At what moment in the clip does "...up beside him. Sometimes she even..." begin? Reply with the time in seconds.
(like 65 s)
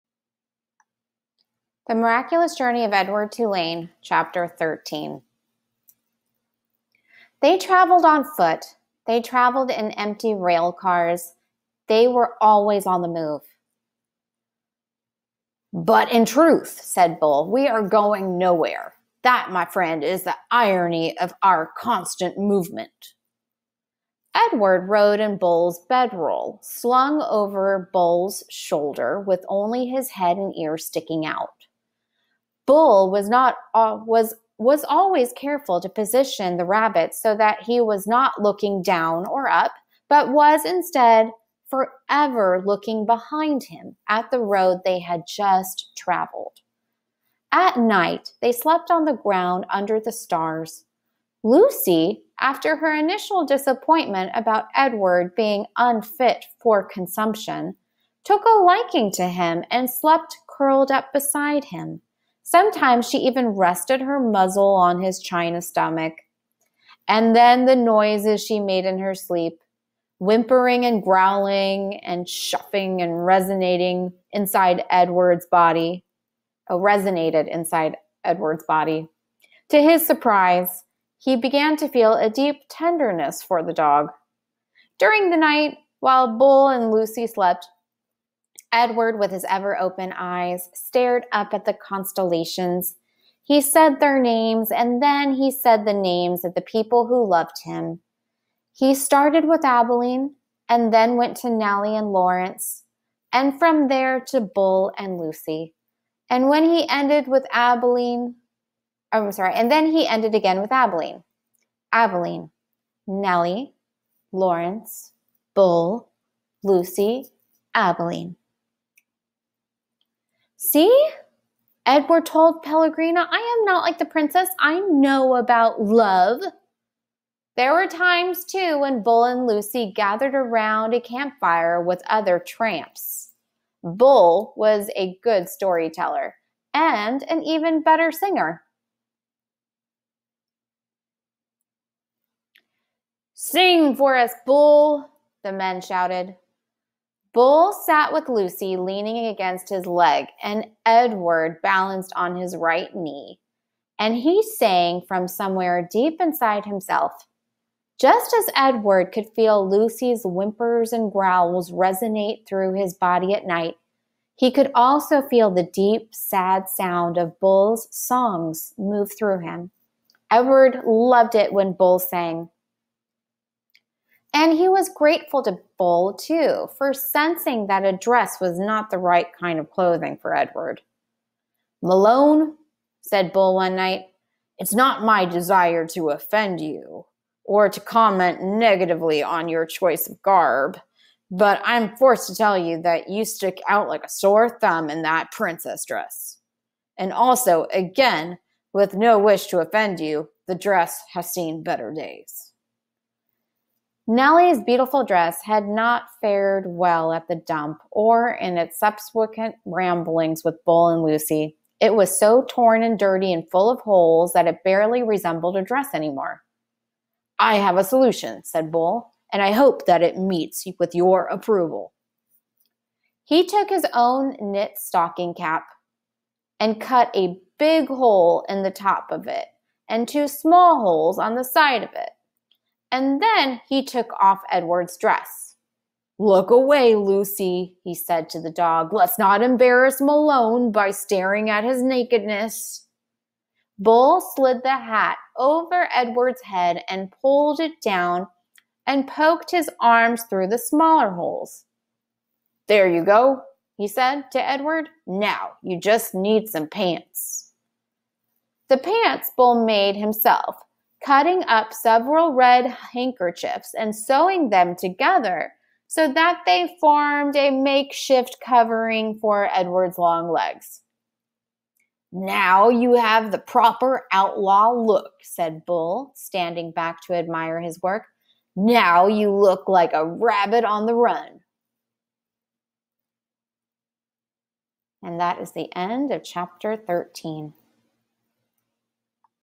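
60 s.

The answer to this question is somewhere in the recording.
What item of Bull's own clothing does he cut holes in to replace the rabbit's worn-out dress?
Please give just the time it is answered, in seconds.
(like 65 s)
224 s.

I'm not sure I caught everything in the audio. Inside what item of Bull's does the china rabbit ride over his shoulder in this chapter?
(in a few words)
Bull's bedroll.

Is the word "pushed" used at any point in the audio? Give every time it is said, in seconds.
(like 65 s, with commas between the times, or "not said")
not said.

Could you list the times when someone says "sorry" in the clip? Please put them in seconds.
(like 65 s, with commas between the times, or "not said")
109 s.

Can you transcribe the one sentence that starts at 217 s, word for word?
I have a solution, said Bull, and I hope that it meets with your approval.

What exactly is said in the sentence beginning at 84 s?
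During the night, while Bull and Lucy slept, Edward, with his ever open eyes, stared up at the constellations.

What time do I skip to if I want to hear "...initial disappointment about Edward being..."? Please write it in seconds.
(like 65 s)
52 s.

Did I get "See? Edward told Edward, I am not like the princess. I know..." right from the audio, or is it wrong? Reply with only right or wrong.
wrong.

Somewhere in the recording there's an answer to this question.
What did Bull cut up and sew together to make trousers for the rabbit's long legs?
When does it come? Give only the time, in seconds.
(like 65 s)
262 s.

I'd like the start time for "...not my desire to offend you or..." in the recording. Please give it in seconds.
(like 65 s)
184 s.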